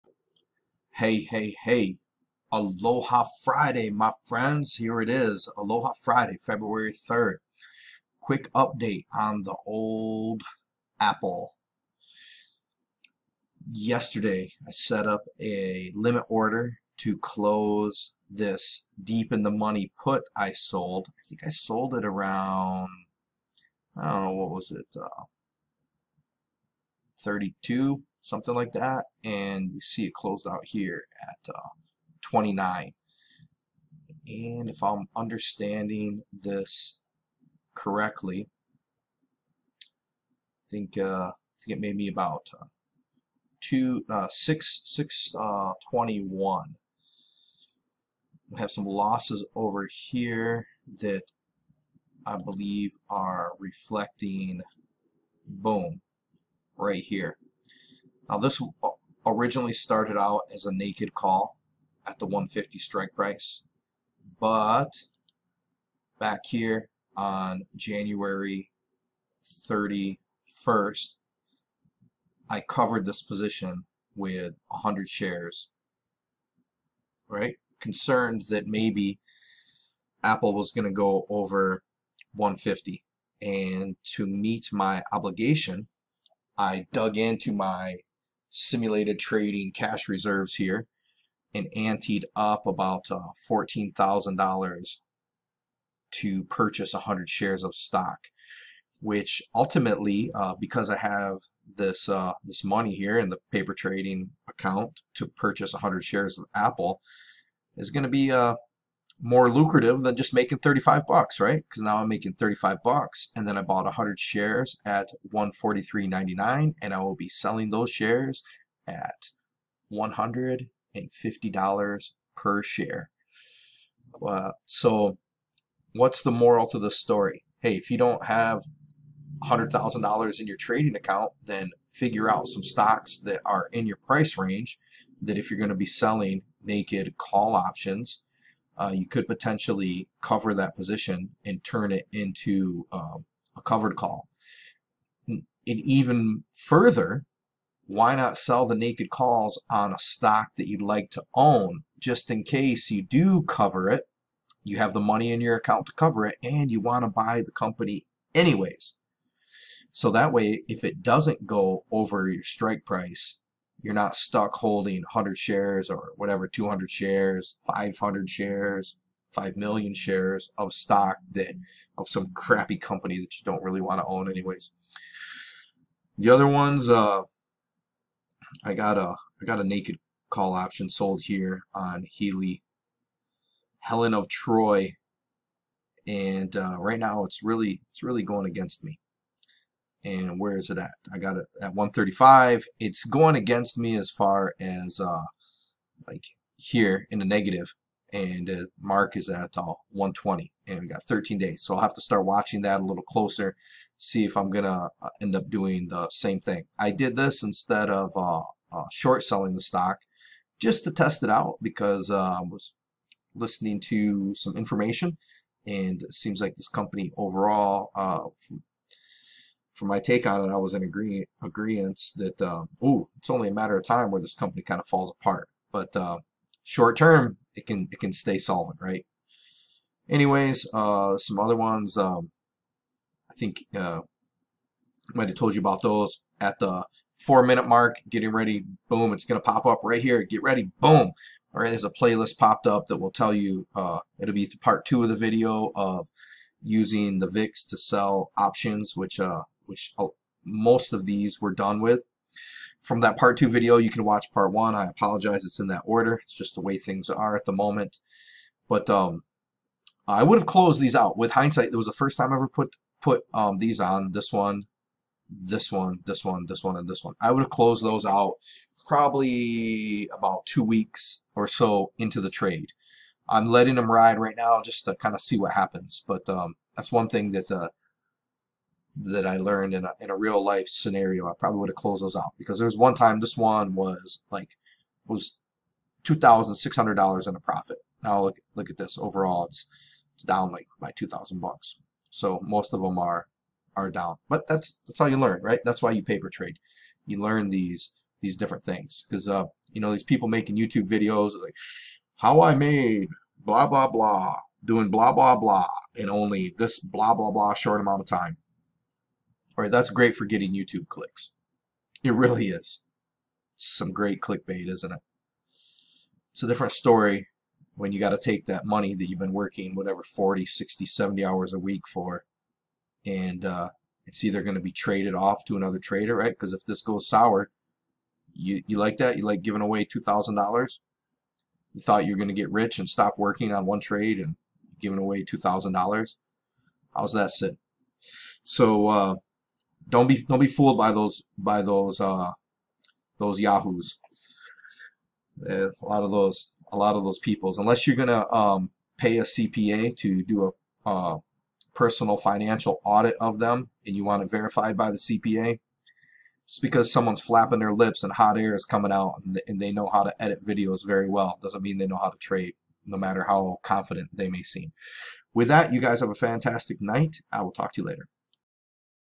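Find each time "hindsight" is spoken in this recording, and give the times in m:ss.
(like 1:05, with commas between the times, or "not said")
4:21.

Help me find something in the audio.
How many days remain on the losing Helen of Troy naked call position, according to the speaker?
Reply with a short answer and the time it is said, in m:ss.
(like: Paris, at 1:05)
13, at 3:21.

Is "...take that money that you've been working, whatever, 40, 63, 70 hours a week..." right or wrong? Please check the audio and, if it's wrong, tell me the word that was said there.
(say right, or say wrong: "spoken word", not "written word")
wrong: "60", not "63".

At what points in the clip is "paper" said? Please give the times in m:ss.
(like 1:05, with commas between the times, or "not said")
1:43, 4:56.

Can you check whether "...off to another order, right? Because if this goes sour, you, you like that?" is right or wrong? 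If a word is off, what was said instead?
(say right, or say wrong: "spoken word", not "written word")
wrong: "trader", not "order".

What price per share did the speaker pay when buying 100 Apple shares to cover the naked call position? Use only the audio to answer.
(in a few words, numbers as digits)
143.99.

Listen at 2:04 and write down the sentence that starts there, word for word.
Uh, so what's the moral to the story?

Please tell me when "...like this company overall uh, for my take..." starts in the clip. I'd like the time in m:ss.
3:36.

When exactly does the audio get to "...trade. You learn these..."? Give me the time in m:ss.
4:56.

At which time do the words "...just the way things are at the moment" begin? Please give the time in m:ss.
4:16.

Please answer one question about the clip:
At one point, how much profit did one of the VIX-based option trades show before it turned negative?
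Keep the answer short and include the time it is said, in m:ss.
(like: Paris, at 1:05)
$2,600, at 4:46.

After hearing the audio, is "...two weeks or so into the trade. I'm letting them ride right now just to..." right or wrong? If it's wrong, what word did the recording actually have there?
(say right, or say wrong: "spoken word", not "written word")
right.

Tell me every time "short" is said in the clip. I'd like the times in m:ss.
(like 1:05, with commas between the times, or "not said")
3:28, 3:46, 5:07.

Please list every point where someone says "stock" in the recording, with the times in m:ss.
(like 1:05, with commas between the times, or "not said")
1:37, 2:12, 2:29, 2:50, 3:29.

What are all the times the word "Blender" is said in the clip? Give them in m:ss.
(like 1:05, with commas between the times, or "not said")
not said.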